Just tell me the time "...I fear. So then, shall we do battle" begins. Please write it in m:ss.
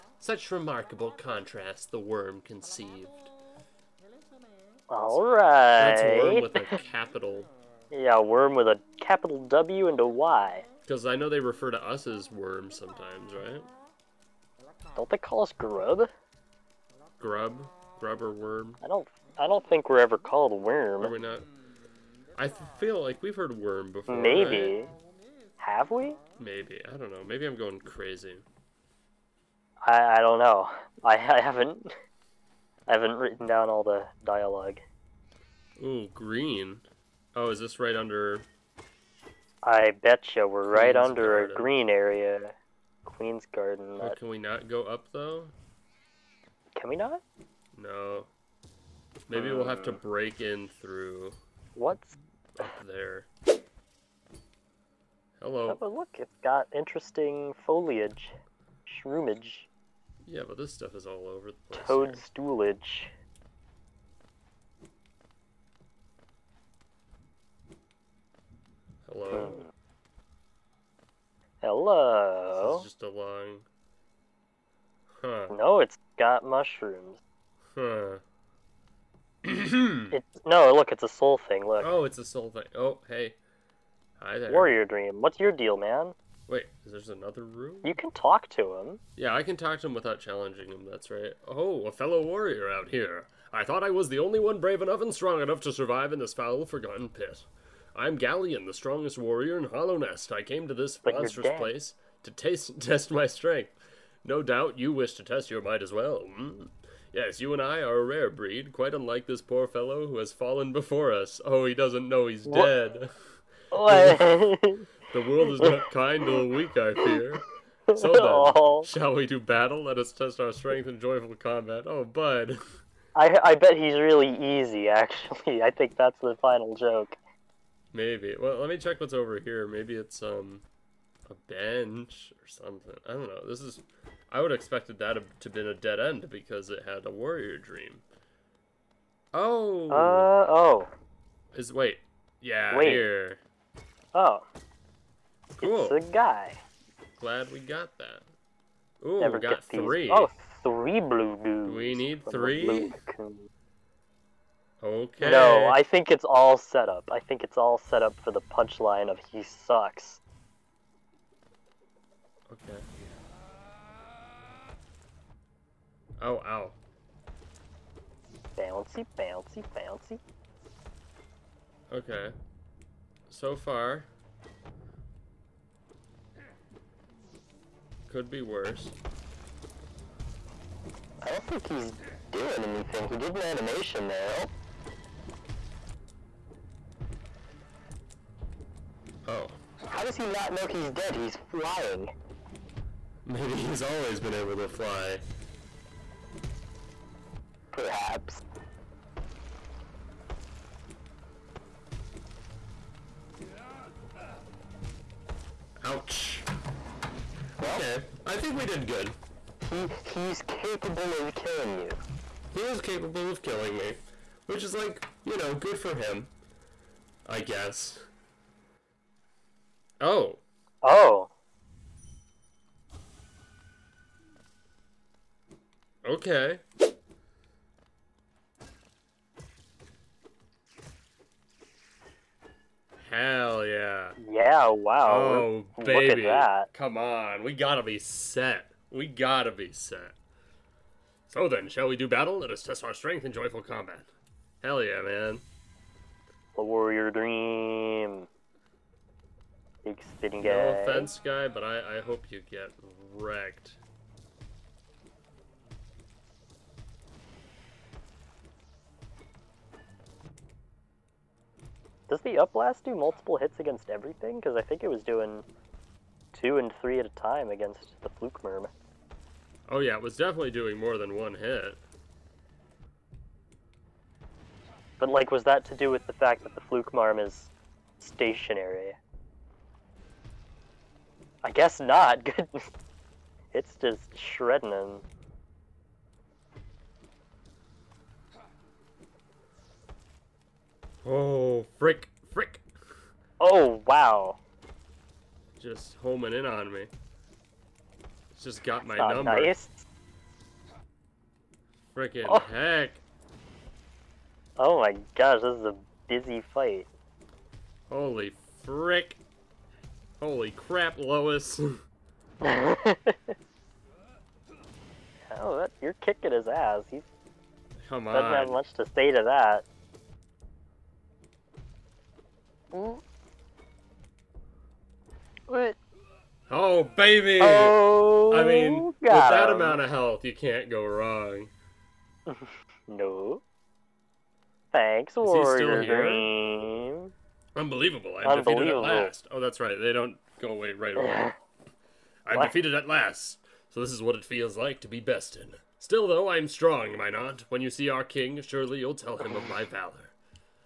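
1:56.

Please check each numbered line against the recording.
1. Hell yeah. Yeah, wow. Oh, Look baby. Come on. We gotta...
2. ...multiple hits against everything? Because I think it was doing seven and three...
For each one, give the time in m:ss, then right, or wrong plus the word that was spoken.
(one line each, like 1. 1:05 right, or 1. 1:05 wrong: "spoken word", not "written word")
1. 3:53 right
2. 4:22 wrong: "two", not "seven".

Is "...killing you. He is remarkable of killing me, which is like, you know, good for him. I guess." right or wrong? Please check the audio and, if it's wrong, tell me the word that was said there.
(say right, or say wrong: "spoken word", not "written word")
wrong: "capable", not "remarkable".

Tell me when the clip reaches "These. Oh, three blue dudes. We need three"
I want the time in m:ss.
2:30.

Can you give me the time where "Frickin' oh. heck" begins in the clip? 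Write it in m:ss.
5:01.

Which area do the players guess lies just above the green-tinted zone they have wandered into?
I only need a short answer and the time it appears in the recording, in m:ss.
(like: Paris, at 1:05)
Queen's Garden, at 0:43.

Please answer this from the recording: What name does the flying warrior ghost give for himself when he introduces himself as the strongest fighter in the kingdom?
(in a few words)
Galien.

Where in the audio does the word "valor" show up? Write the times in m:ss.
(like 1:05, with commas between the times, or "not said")
5:49.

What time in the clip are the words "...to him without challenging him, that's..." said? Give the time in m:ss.
1:29.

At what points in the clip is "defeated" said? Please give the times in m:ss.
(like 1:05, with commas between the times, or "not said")
5:38, 5:42.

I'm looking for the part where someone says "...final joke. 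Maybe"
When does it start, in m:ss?
2:06.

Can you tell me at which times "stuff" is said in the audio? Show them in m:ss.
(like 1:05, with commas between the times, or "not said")
1:00.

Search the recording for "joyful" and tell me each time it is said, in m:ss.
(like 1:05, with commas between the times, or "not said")
2:00, 4:03.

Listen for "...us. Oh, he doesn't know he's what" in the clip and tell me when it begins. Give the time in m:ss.
1:51.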